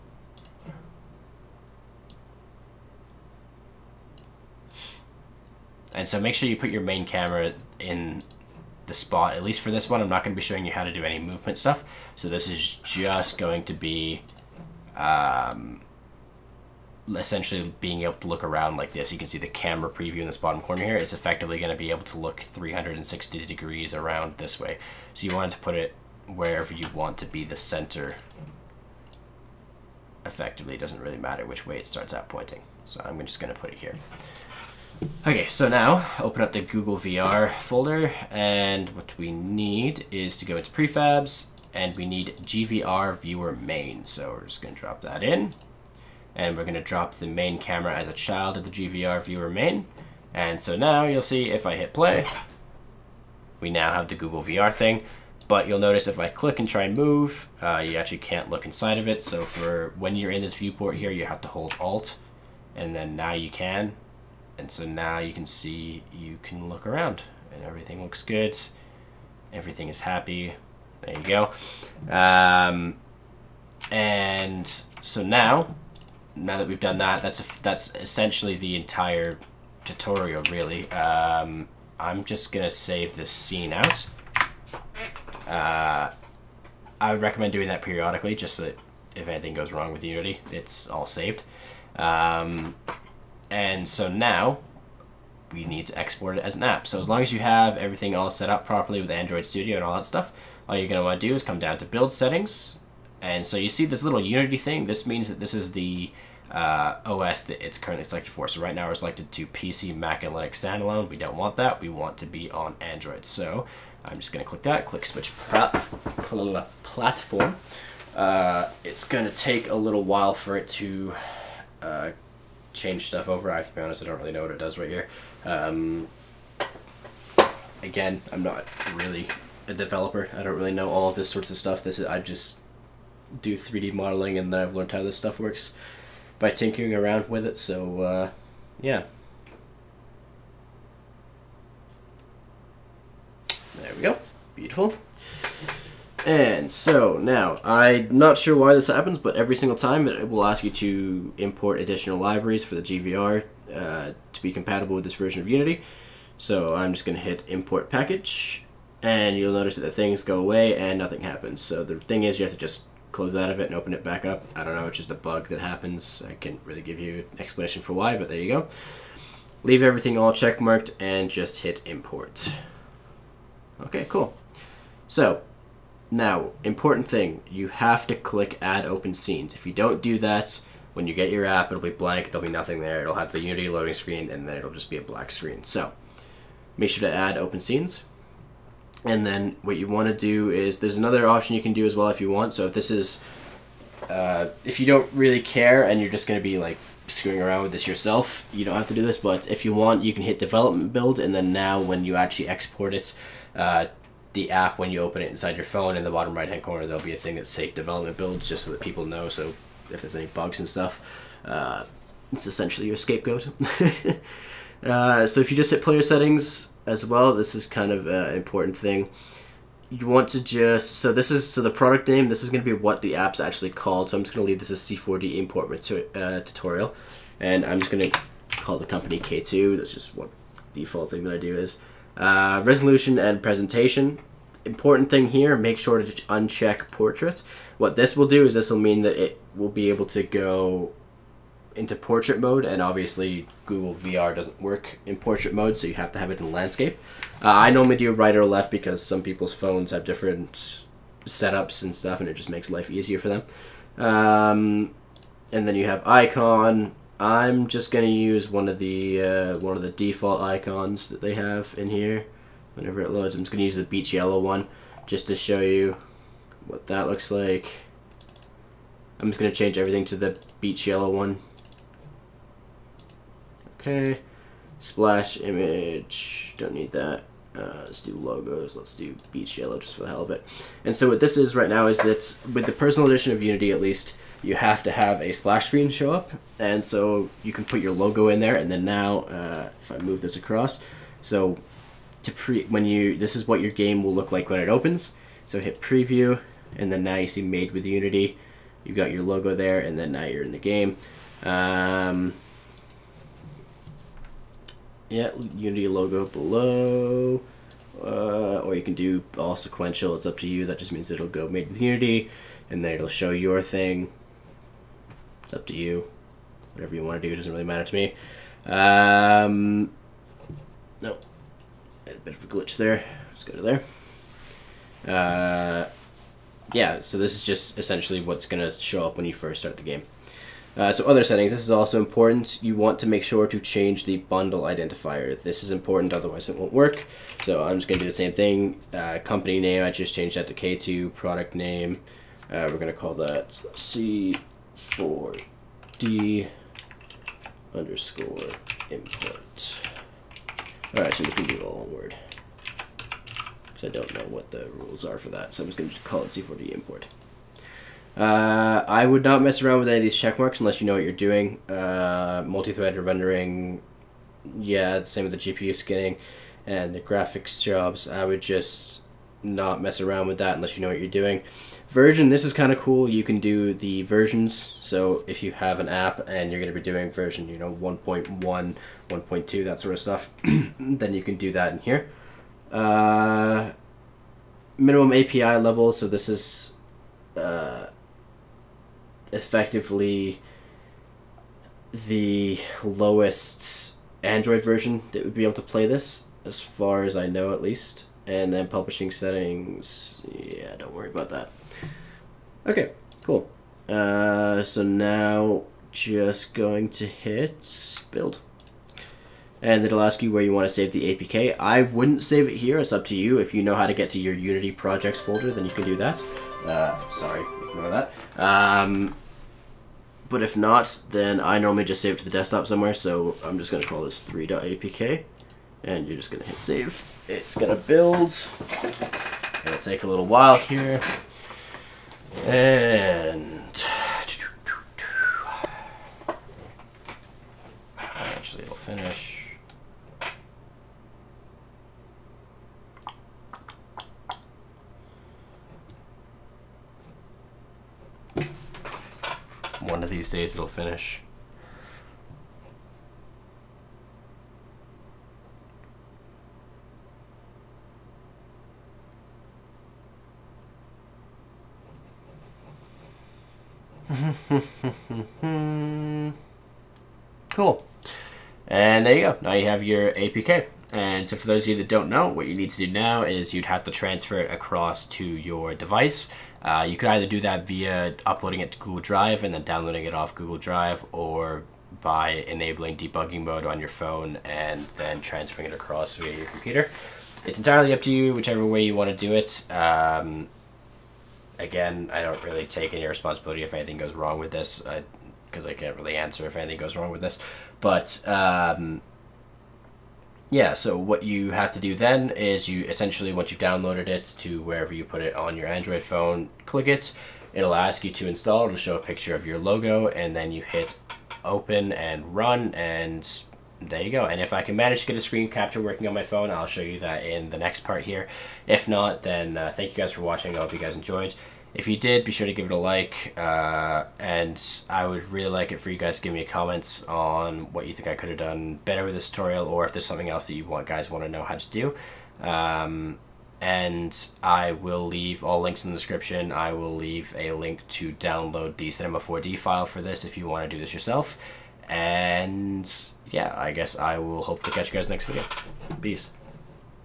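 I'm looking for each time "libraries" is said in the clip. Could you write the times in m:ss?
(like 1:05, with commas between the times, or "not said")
2:32.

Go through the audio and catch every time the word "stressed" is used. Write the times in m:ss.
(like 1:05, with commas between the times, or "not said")
not said.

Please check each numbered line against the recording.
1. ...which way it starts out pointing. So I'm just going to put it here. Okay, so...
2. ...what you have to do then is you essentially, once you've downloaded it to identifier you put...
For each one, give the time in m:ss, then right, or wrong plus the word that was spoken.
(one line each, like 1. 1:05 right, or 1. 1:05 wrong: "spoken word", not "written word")
1. 0:31 right
2. 8:20 wrong: "wherever", not "identifier".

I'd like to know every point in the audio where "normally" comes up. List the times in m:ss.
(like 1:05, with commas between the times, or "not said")
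4:07, 7:01.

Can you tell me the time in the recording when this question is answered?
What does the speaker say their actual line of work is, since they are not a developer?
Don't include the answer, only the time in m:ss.
2:13.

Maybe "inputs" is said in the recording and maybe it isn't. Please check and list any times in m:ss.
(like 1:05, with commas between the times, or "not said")
not said.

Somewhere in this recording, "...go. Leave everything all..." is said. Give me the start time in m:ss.
2:48.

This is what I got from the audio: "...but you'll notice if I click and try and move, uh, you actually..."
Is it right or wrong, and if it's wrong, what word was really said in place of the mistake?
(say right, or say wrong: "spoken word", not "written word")
right.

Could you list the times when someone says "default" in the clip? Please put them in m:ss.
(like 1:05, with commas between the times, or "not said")
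3:50, 4:19.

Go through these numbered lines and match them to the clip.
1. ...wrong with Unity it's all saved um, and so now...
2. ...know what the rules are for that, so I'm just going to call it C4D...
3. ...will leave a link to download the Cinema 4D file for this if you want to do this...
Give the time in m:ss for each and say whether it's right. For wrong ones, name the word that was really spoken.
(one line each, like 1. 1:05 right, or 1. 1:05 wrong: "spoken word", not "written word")
1. 1:29 right
2. 5:54 right
3. 8:56 right.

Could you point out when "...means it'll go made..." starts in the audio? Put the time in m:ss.
5:10.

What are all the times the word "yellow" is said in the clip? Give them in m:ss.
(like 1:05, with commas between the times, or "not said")
4:24, 4:30, 4:39.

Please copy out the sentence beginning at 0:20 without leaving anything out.
It's effectively going to be able to look 360 degrees around this way.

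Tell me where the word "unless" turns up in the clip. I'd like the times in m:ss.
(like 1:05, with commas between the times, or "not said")
6:00, 6:10.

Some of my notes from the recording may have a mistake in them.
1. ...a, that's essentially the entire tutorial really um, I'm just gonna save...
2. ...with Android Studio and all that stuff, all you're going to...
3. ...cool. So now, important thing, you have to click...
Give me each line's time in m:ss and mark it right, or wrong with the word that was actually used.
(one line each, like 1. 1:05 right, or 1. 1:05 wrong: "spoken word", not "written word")
1. 1:17 right
2. 1:39 right
3. 2:54 right.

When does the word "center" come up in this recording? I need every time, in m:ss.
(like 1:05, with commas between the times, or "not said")
0:27.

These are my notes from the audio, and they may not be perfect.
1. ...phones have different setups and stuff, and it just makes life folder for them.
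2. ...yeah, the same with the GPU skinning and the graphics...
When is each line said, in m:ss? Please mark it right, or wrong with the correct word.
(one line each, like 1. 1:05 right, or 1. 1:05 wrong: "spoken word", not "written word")
1. 4:09 wrong: "easier", not "folder"
2. 6:04 right.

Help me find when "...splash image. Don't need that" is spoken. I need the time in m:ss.
4:34.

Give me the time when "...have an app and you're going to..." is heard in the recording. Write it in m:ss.
6:15.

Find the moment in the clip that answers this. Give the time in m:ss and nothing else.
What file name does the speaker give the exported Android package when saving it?
7:04.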